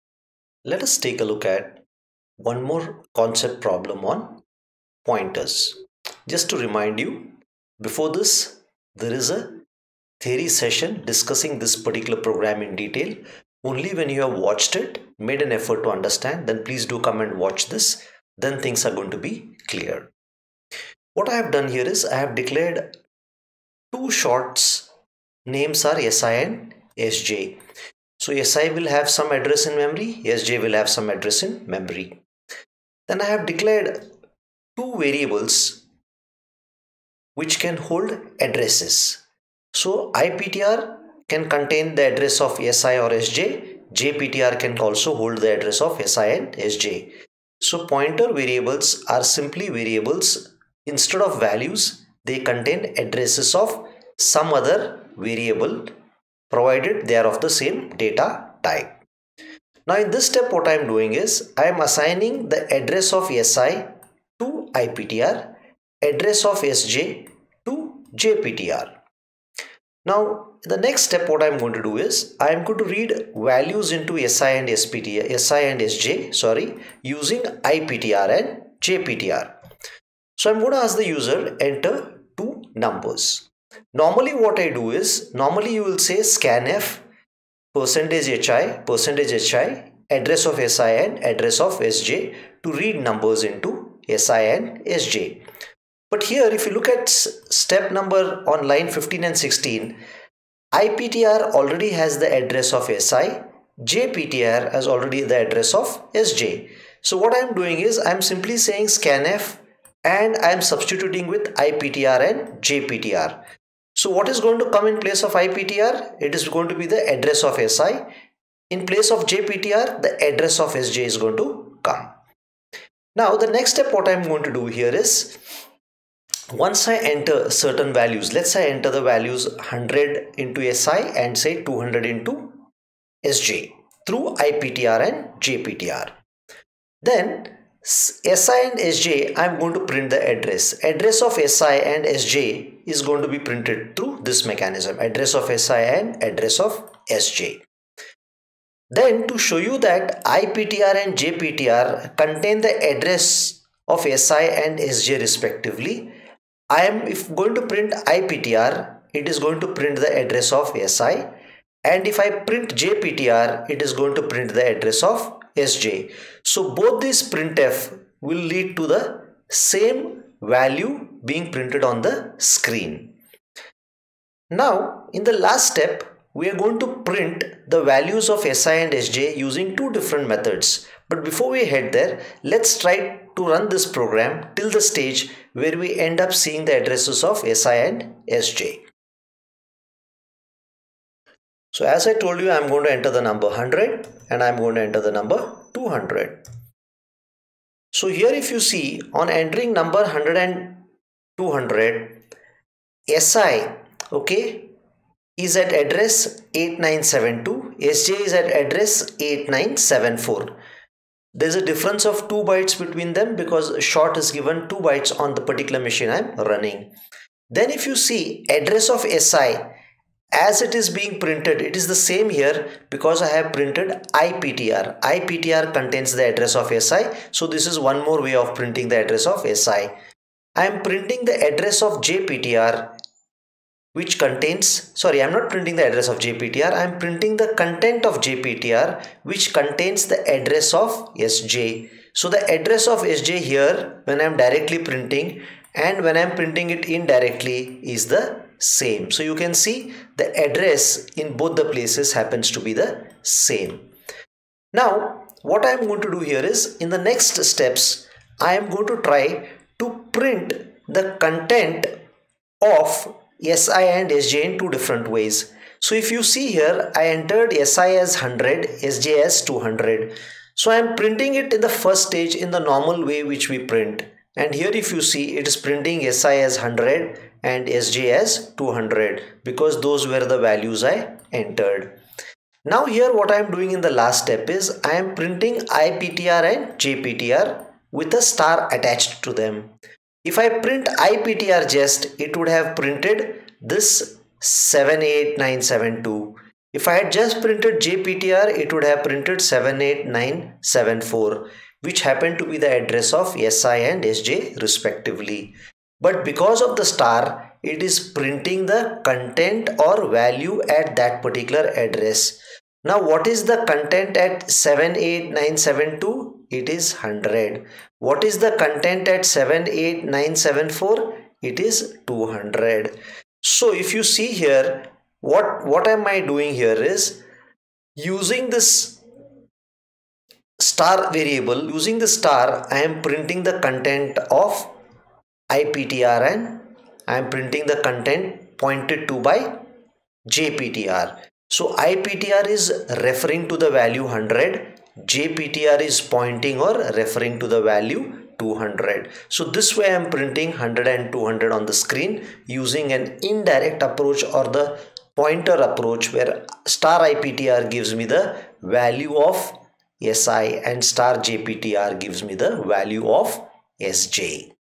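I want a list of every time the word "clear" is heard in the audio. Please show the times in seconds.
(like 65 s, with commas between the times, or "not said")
19 s.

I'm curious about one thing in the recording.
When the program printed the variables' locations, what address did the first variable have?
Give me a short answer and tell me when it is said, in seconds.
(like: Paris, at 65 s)
8972, at 206 s.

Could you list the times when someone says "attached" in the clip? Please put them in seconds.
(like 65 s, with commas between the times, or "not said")
288 s.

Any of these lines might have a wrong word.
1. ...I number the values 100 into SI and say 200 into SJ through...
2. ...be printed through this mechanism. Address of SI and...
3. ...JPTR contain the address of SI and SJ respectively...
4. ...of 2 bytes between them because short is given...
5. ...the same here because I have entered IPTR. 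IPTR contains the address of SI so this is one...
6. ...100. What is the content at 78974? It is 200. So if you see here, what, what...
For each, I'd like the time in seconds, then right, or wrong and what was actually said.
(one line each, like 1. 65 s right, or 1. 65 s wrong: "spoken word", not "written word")
1. 128 s wrong: "enter", not "number"
2. 143 s right
3. 151 s right
4. 212 s right
5. 221 s wrong: "printed", not "entered"
6. 316 s right.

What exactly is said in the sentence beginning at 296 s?
If I had just printed JPTR it would have printed 78974 which happen to be the address of SI and SJ respectively.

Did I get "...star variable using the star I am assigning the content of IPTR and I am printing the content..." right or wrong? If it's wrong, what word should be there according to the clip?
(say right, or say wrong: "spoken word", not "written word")
wrong: "printing", not "assigning".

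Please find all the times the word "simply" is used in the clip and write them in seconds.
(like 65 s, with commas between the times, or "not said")
49 s, 108 s.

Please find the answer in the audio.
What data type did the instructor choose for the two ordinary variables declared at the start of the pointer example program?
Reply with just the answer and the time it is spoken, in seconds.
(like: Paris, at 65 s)
short, at 23 s.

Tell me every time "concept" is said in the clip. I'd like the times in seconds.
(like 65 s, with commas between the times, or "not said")
3 s.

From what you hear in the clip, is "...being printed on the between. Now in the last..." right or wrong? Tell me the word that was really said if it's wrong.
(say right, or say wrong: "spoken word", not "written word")
wrong: "screen", not "between".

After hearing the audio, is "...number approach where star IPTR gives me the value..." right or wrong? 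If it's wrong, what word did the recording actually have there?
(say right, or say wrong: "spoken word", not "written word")
wrong: "pointer", not "number".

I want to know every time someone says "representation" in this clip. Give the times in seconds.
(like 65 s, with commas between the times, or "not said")
not said.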